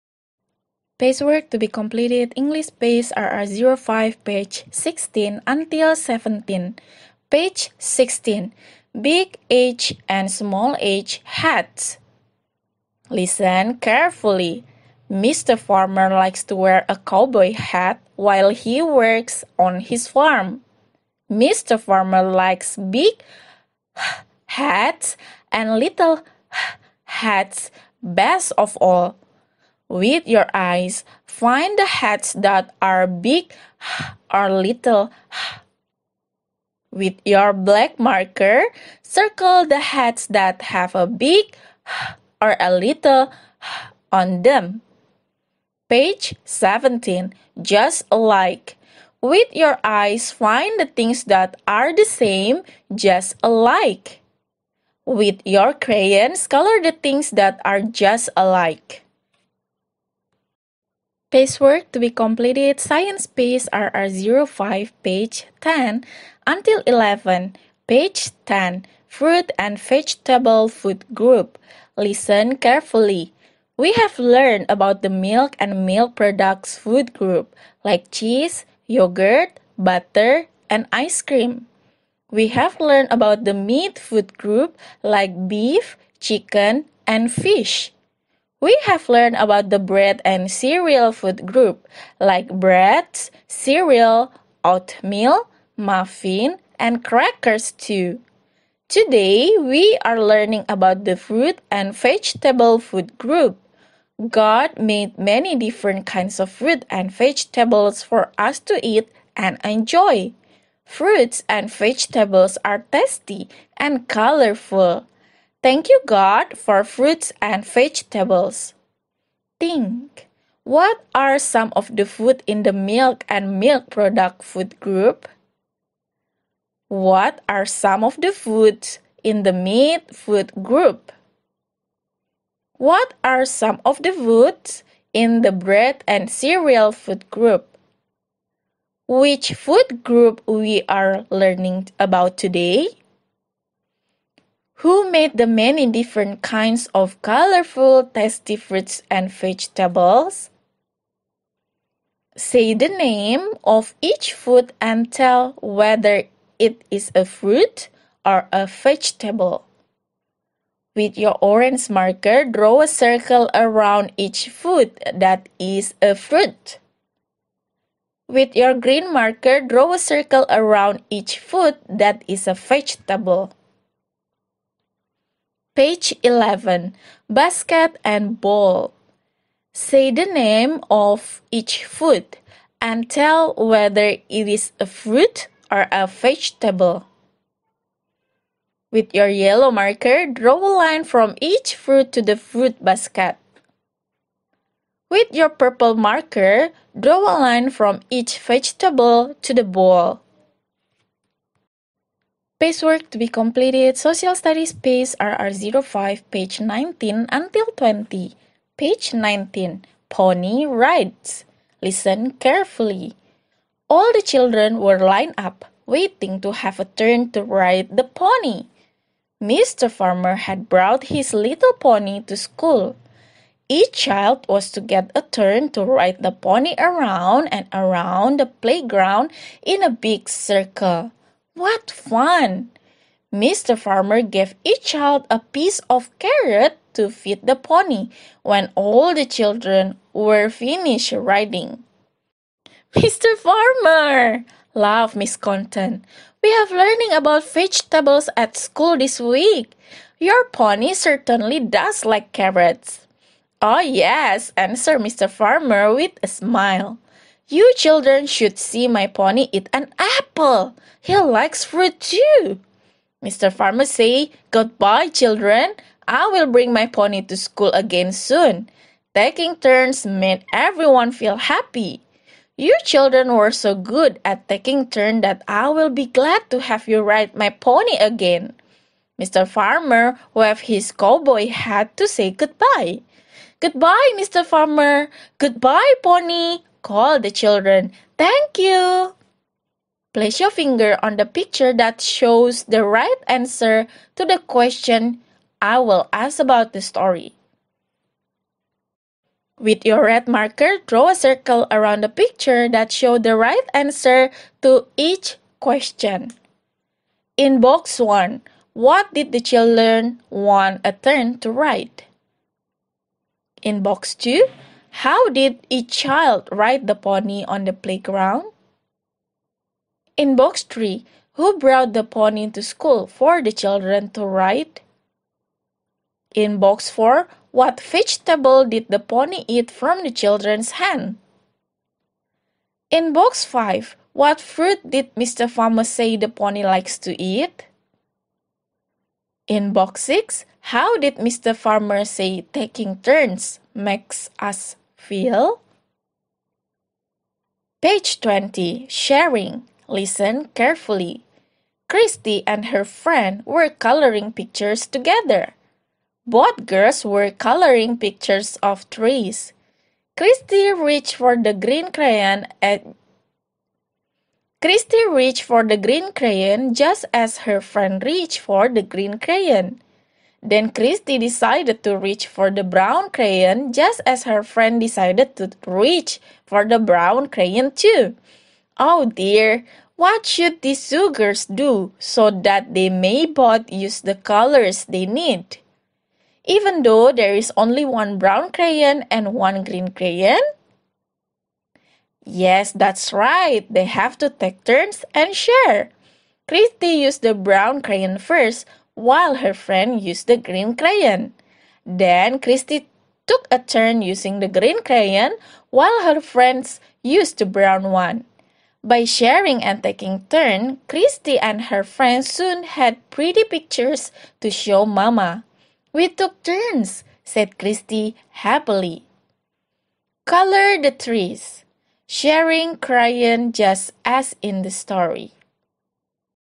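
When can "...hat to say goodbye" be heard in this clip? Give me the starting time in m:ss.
4:41.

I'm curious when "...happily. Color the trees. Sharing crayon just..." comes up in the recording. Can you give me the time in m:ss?
6:58.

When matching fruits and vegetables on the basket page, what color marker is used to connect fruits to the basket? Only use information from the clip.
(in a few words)
yellow.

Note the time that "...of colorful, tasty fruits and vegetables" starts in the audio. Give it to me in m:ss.
2:26.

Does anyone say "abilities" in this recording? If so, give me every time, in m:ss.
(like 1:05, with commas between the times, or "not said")
not said.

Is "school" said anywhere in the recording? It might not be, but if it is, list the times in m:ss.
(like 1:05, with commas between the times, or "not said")
3:42, 4:08, 4:27, 5:22.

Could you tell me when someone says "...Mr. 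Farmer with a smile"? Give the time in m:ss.
4:14.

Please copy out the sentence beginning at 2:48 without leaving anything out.
With your green marker, draw a circle around each food that is a vegetable.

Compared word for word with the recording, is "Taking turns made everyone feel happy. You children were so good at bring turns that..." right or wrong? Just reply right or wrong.
wrong.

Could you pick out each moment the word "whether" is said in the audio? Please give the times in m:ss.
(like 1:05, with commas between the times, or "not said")
2:35, 3:03.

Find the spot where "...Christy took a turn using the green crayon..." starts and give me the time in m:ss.
6:42.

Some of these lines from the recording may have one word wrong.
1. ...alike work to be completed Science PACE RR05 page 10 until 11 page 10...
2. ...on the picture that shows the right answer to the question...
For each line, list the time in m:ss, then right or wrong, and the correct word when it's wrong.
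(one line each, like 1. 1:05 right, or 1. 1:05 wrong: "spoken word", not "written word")
1. 0:58 right
2. 4:51 right.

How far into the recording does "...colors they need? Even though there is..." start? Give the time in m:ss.
6:24.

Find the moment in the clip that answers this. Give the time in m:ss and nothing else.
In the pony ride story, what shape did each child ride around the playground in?
3:49.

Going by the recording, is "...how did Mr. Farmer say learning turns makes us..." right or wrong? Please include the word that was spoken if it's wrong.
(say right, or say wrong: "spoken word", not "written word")
wrong: "taking", not "learning".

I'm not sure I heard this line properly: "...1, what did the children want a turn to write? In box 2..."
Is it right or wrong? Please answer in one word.
right.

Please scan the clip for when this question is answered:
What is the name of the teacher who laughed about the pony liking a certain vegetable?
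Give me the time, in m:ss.
4:05.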